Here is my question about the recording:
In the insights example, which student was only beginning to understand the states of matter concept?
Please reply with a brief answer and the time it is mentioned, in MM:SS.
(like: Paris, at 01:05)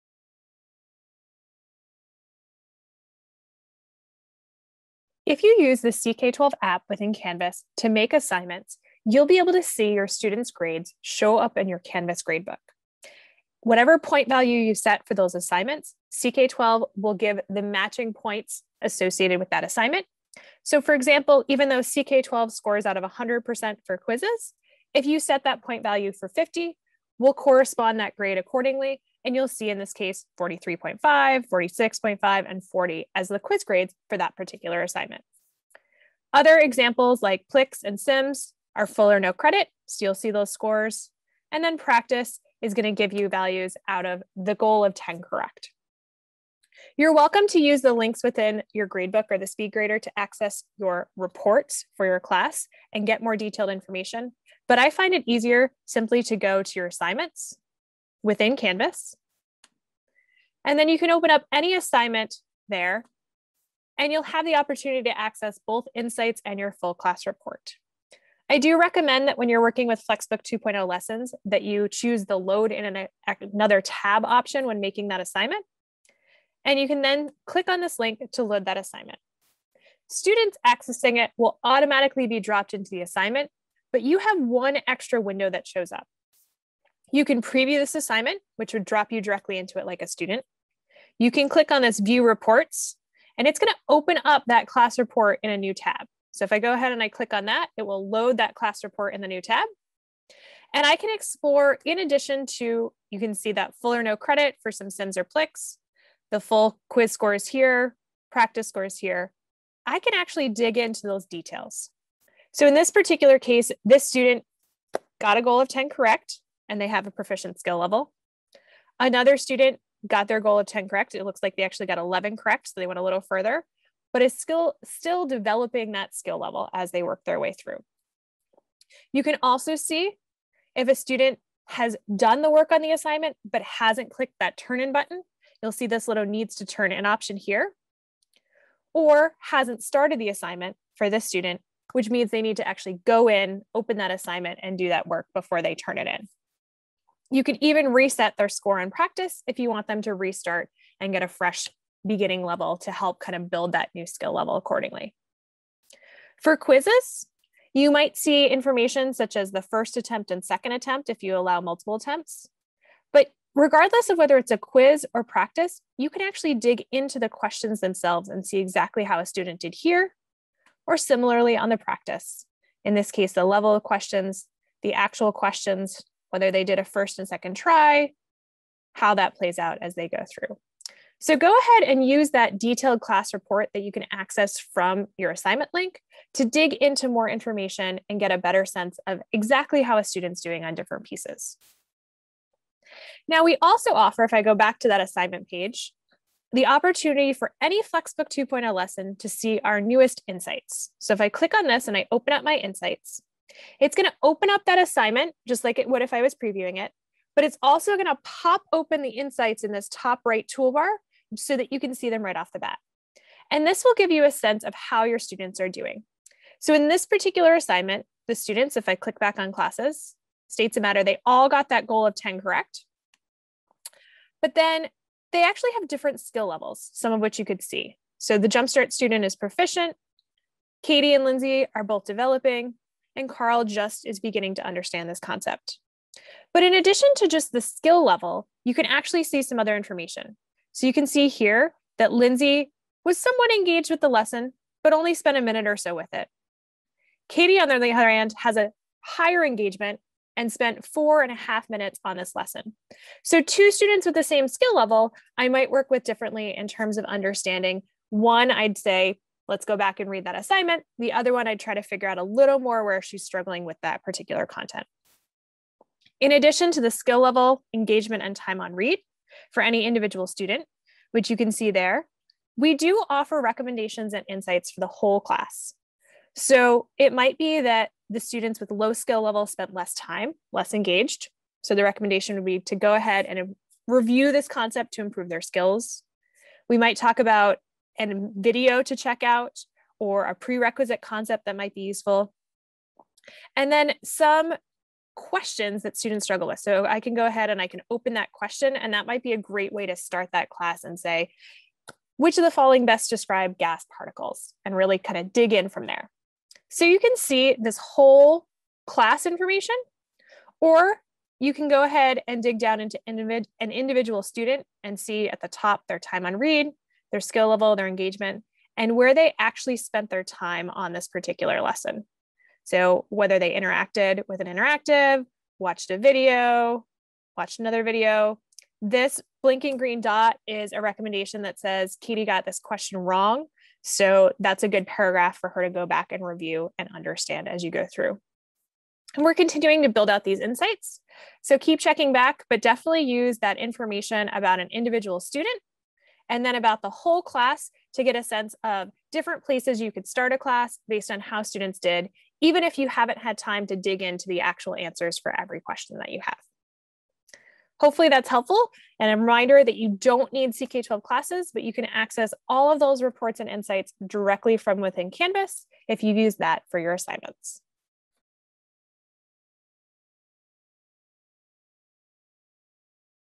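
Carl, at 03:53.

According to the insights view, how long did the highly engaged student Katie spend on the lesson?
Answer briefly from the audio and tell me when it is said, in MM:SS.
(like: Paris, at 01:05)
four and a half minutes, at 04:10.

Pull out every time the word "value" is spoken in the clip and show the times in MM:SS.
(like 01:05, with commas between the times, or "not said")
00:14, 00:25, 00:43.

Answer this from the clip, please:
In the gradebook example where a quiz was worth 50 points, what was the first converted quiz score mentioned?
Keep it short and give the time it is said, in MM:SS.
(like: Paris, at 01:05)
43.5, at 00:30.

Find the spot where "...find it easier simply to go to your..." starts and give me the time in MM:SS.
00:54.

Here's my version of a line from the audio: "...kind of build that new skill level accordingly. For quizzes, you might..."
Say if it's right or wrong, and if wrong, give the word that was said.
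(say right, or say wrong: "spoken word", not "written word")
right.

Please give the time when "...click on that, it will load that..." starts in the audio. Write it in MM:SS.
01:37.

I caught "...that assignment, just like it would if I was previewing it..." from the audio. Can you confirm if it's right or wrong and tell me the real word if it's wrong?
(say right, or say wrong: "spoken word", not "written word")
right.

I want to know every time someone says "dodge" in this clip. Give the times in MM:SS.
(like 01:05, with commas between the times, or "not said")
not said.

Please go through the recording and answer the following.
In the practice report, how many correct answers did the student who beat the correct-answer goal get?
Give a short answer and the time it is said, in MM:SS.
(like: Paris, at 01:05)
11, at 02:01.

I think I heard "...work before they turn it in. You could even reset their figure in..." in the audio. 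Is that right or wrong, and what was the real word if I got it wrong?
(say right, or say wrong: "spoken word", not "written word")
wrong: "score", not "figure".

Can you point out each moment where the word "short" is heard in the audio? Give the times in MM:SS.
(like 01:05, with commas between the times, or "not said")
not said.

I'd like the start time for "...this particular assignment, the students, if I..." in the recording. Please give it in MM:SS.
03:36.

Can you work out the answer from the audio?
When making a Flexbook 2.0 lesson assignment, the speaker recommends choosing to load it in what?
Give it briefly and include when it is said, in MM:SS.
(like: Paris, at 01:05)
another tab, at 01:13.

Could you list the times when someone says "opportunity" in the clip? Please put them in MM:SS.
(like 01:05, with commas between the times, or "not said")
01:04, 03:16.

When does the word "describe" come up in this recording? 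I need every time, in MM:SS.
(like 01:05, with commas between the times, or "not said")
05:03.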